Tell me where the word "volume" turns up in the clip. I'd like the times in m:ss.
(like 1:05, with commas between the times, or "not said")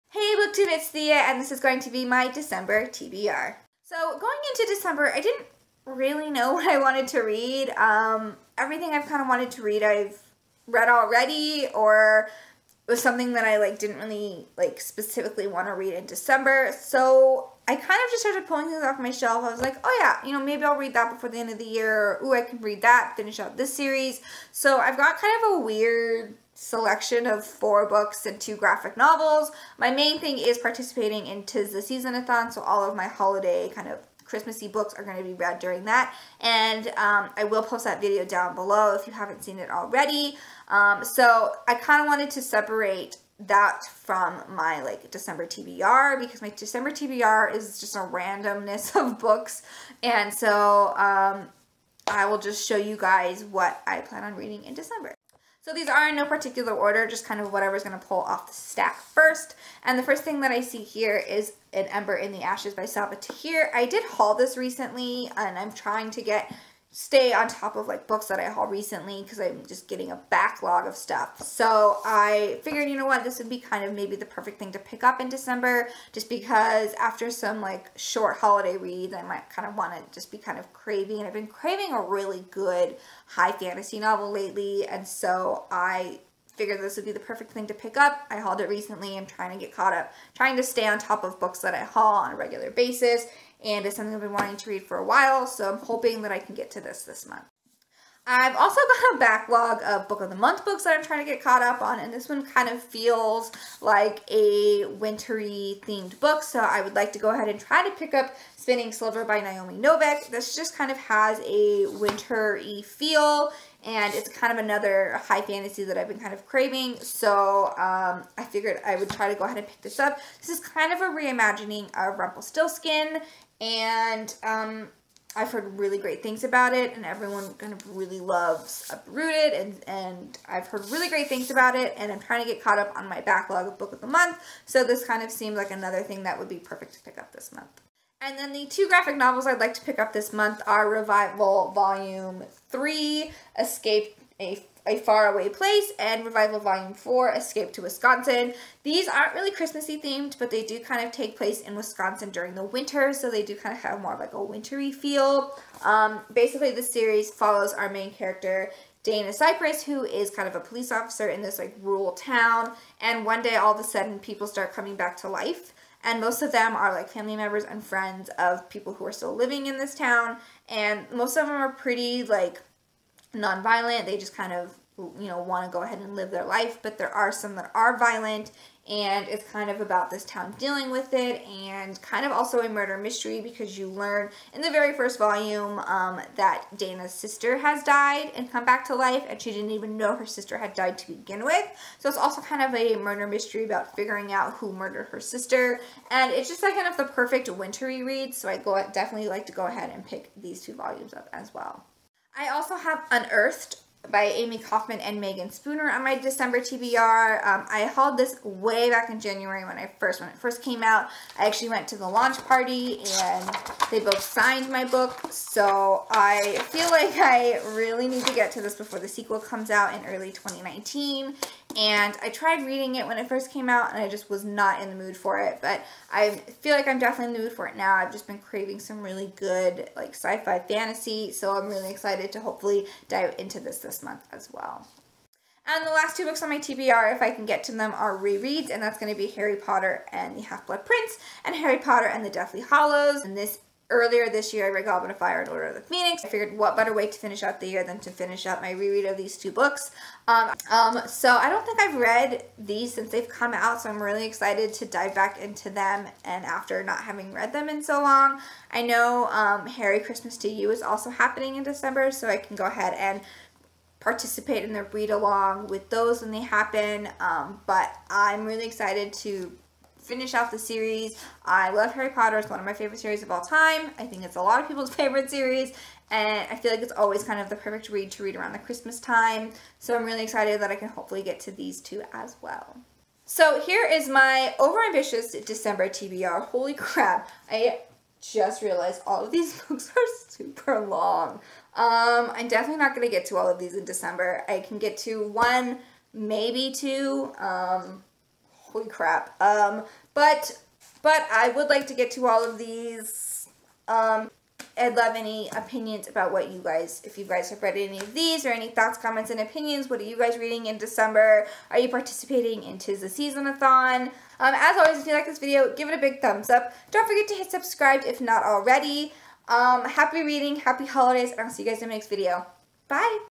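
2:21, 2:26, 3:05, 3:20.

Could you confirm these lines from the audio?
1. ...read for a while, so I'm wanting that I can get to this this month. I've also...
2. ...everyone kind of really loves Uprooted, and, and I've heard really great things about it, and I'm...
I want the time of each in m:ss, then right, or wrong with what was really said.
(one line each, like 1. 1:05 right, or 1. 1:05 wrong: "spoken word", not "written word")
1. 1:34 wrong: "hoping", not "wanting"
2. 2:07 right.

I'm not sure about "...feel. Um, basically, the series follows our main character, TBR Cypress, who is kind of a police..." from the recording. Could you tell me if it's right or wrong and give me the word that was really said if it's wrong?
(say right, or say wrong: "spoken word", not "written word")
wrong: "Dana", not "TBR".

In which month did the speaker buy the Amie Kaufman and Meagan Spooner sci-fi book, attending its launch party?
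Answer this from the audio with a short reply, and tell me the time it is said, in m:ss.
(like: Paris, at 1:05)
January, at 3:29.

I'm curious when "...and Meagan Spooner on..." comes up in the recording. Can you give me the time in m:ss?
3:24.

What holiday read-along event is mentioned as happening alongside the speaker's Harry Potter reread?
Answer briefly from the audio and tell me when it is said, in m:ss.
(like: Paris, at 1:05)
Harry Christmas to You, at 4:19.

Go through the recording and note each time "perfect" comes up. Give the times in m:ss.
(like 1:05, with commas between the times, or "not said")
1:14, 1:27, 2:16, 3:17, 4:37.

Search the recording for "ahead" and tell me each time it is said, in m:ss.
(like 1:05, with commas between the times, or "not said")
1:47, 1:59, 2:55, 3:19, 4:22.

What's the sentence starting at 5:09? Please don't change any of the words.
What are you guys reading in December?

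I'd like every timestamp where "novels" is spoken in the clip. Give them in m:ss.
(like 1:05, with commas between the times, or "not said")
0:28, 1:23, 2:19.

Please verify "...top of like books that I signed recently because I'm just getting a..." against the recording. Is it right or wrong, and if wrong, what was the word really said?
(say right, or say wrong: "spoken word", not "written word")
wrong: "hauled", not "signed".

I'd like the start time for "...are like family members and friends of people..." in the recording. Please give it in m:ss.
2:46.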